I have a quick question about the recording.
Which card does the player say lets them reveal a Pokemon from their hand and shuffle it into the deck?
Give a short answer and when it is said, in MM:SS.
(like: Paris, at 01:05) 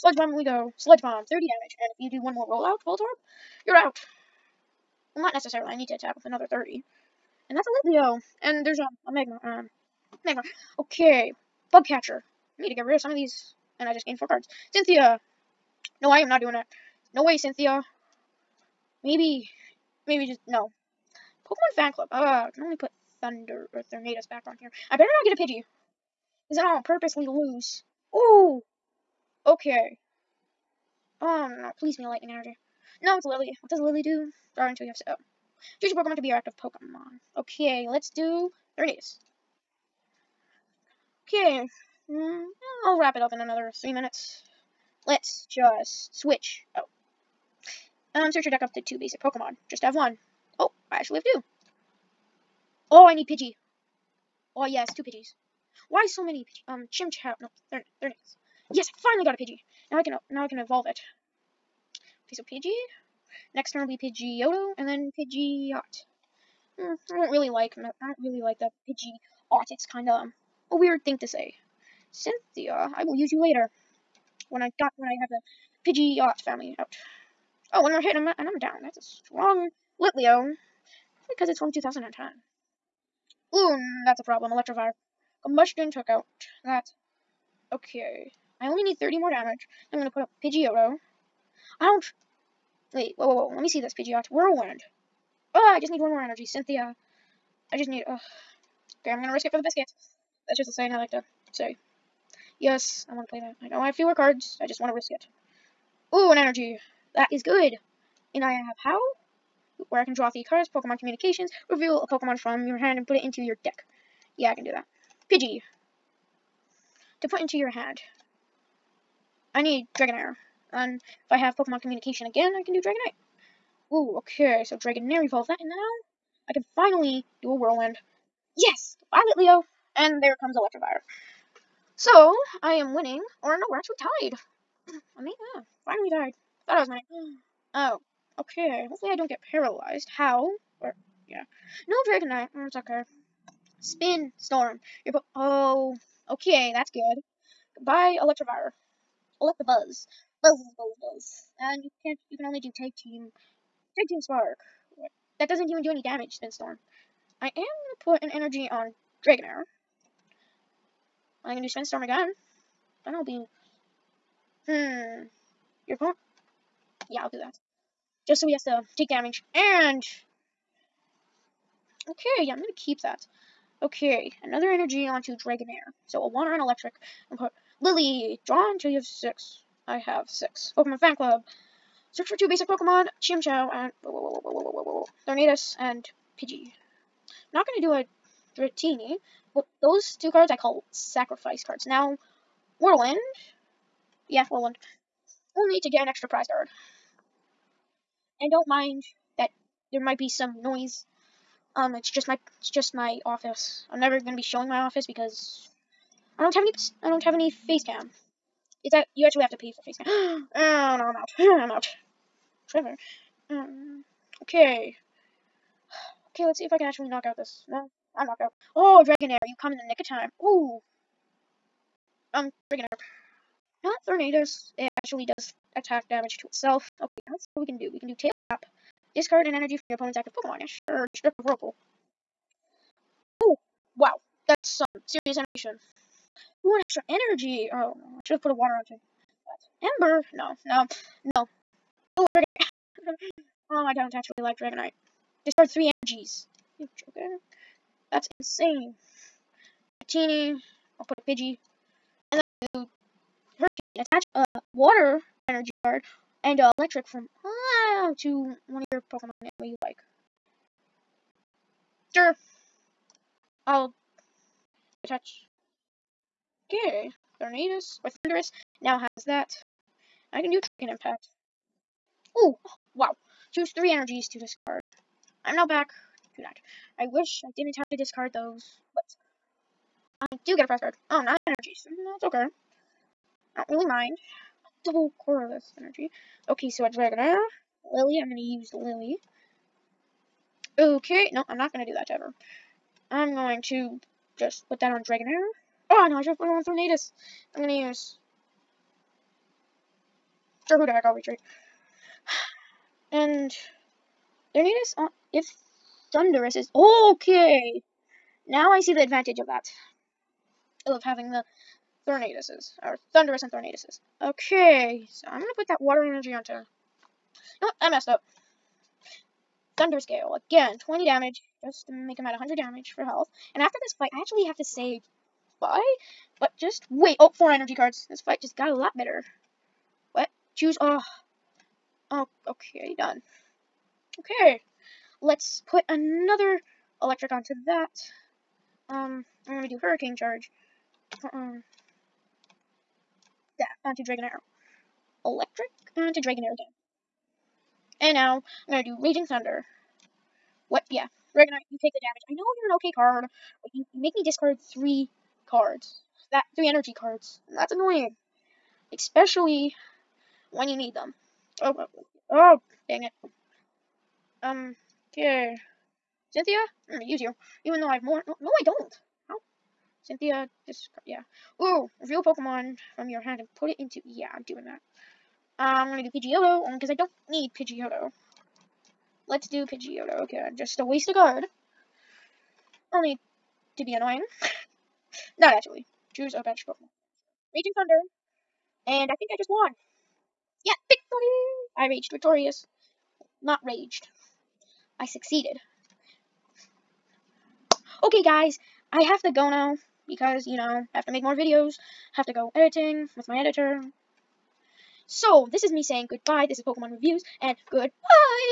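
Pokemon Communication, at 01:50.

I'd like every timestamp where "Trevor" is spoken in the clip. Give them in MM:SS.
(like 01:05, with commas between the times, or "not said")
03:32.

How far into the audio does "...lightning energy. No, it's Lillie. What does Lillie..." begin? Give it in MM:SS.
00:32.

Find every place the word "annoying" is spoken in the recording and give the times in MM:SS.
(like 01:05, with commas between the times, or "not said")
05:57, 06:23.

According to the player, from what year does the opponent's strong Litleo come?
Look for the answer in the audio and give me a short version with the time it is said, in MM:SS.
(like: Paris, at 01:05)
2010, at 01:21.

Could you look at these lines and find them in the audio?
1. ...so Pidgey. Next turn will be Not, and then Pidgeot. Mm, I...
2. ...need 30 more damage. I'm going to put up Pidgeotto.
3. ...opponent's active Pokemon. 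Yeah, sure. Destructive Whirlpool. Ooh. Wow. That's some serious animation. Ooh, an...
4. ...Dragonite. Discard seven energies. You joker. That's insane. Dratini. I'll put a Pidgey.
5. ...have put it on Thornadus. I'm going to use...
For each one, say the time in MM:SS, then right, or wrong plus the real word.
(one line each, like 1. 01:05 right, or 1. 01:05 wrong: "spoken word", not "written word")
1. 01:02 wrong: "Pidgeotto", not "Not"
2. 01:28 right
3. 03:49 right
4. 04:04 wrong: "three", not "seven"
5. 04:56 right.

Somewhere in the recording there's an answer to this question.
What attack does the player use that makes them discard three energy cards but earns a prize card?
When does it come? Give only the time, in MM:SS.
04:30.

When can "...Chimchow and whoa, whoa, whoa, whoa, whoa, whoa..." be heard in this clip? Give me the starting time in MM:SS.
03:03.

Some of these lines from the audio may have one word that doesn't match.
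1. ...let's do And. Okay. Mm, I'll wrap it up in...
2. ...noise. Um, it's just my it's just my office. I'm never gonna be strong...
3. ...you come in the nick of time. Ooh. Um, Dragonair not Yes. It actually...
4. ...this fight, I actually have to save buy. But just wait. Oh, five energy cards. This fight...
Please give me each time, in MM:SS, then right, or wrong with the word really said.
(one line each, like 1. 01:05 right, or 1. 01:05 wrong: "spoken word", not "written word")
1. 00:37 wrong: "Ernest", not "And"
2. 03:20 wrong: "showing", not "strong"
3. 03:39 wrong: "Tornadus", not "Yes"
4. 05:23 wrong: "four", not "five".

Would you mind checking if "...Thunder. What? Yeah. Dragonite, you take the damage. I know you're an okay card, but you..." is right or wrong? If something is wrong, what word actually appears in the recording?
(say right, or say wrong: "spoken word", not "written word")
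right.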